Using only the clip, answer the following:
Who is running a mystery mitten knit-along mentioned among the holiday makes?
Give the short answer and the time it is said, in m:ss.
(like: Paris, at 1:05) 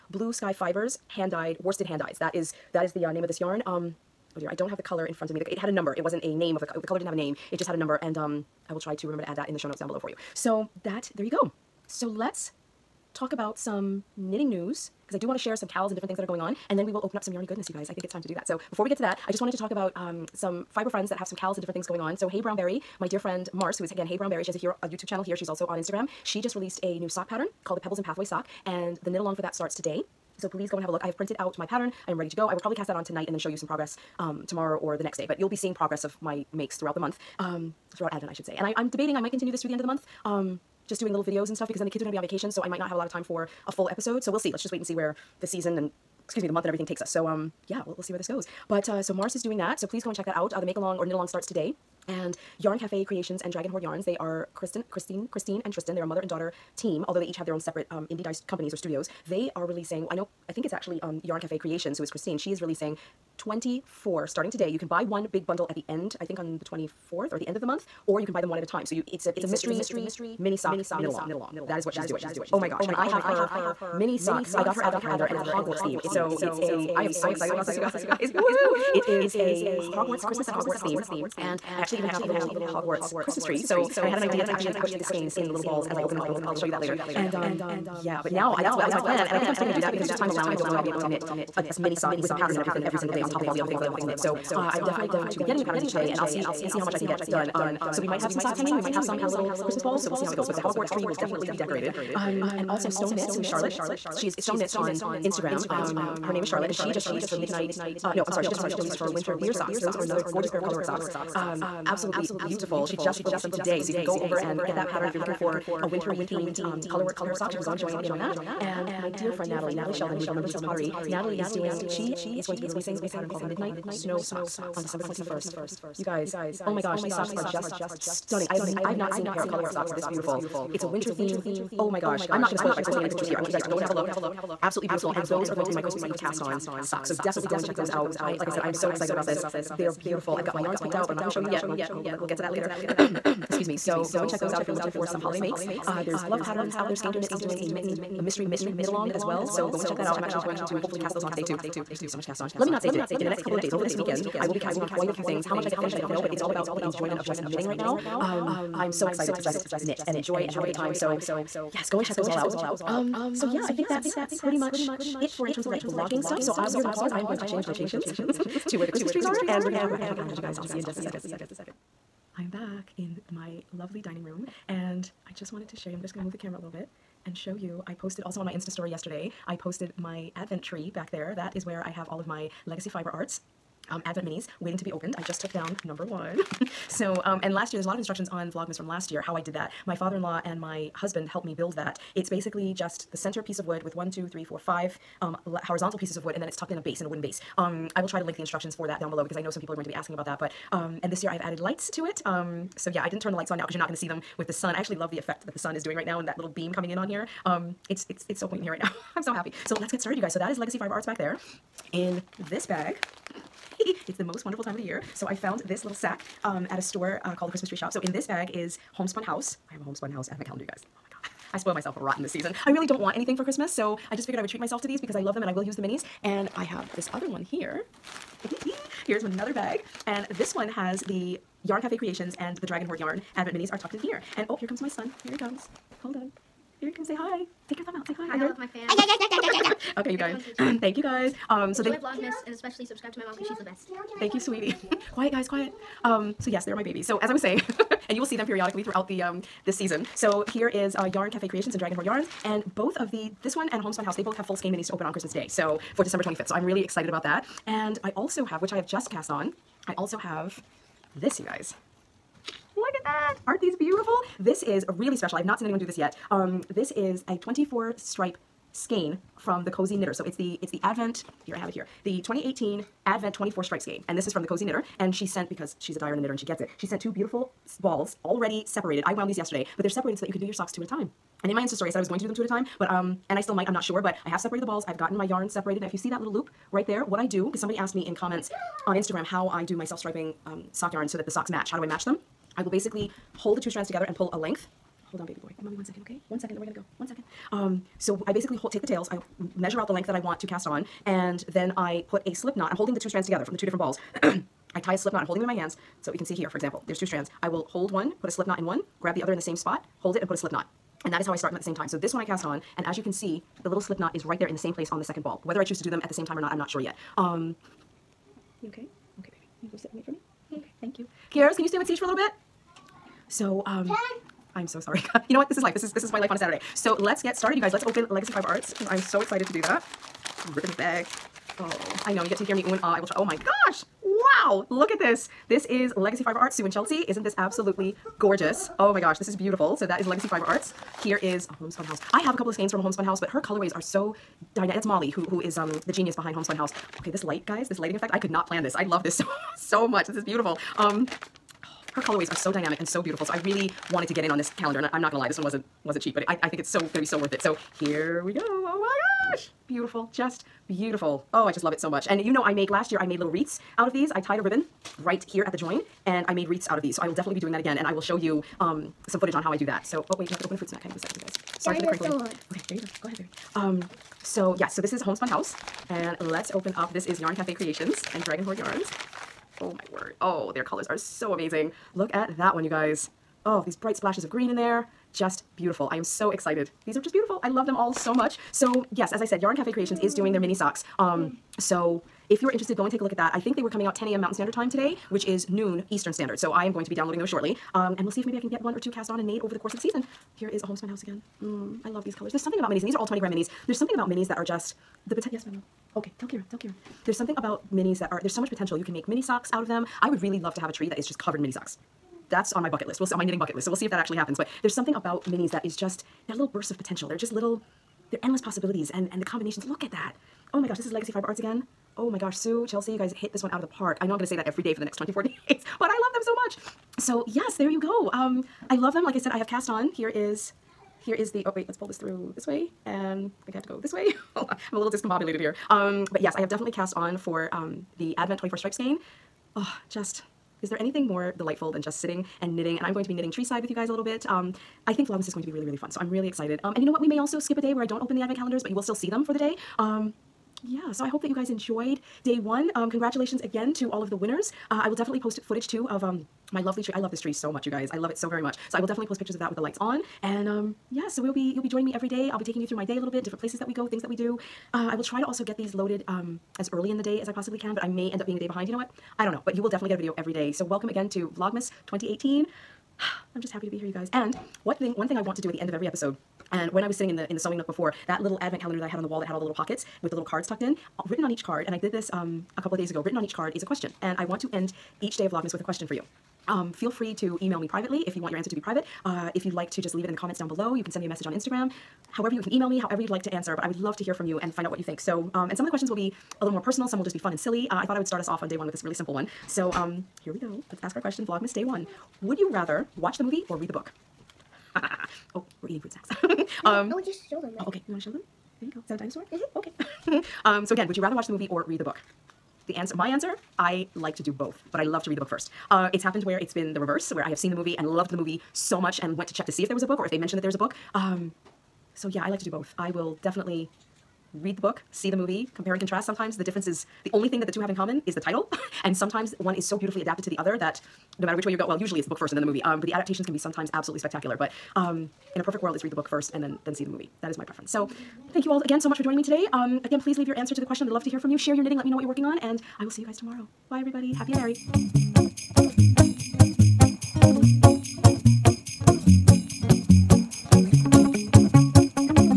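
Skander Knits, at 2:26.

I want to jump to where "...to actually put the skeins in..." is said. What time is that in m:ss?
1:24.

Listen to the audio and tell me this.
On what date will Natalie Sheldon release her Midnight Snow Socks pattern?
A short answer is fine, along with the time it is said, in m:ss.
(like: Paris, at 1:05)
December 21st, at 2:04.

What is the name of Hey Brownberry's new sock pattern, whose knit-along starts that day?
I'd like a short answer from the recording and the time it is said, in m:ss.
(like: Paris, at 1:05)
Pebbles and Pathway Sock, at 0:27.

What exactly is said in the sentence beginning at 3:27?
Um, it's, it's, it's so quaint in here right now.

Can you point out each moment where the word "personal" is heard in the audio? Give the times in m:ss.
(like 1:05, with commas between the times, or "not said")
8:16.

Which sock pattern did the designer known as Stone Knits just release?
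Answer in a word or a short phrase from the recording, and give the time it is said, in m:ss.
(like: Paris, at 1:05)
Winter Deer Socks, at 1:49.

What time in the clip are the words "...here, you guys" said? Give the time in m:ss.
7:53.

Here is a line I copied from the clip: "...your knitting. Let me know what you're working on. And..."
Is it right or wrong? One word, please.
right.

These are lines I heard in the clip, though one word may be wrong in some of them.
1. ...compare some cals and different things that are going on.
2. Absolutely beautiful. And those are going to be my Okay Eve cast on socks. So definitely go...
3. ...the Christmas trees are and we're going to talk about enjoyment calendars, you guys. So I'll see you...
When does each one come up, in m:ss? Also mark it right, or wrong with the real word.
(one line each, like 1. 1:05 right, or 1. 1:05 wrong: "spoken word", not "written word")
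1. 0:15 wrong: "share", not "compare"
2. 2:14 wrong: "Christmas", not "Okay"
3. 2:48 wrong: "advent", not "enjoyment".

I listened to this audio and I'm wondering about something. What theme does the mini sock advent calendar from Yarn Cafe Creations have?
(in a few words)
Christmas at Hogwarts.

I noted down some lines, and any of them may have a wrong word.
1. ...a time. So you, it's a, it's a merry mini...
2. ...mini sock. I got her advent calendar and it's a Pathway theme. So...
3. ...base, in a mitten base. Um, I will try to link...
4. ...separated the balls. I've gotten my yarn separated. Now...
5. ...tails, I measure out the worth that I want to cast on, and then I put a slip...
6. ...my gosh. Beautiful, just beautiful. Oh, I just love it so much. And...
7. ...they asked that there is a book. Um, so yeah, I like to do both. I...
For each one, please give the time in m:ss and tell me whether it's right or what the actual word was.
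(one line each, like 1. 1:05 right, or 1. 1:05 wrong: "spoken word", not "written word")
1. 1:08 wrong: "mystery", not "merry"
2. 1:13 wrong: "Hogwarts", not "Pathway"
3. 3:16 wrong: "wooden", not "mitten"
4. 4:44 right
5. 4:58 wrong: "length", not "worth"
6. 5:58 right
7. 8:40 wrong: "mentioned", not "asked".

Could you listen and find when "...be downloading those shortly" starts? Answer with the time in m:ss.
6:36.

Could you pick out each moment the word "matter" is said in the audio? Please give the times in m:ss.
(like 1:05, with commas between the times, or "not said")
8:51.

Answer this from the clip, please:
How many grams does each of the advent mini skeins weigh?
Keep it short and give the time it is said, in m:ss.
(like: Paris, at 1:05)
20, at 6:43.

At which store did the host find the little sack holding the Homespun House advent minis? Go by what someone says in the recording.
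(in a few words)
Christmas Tree Shop.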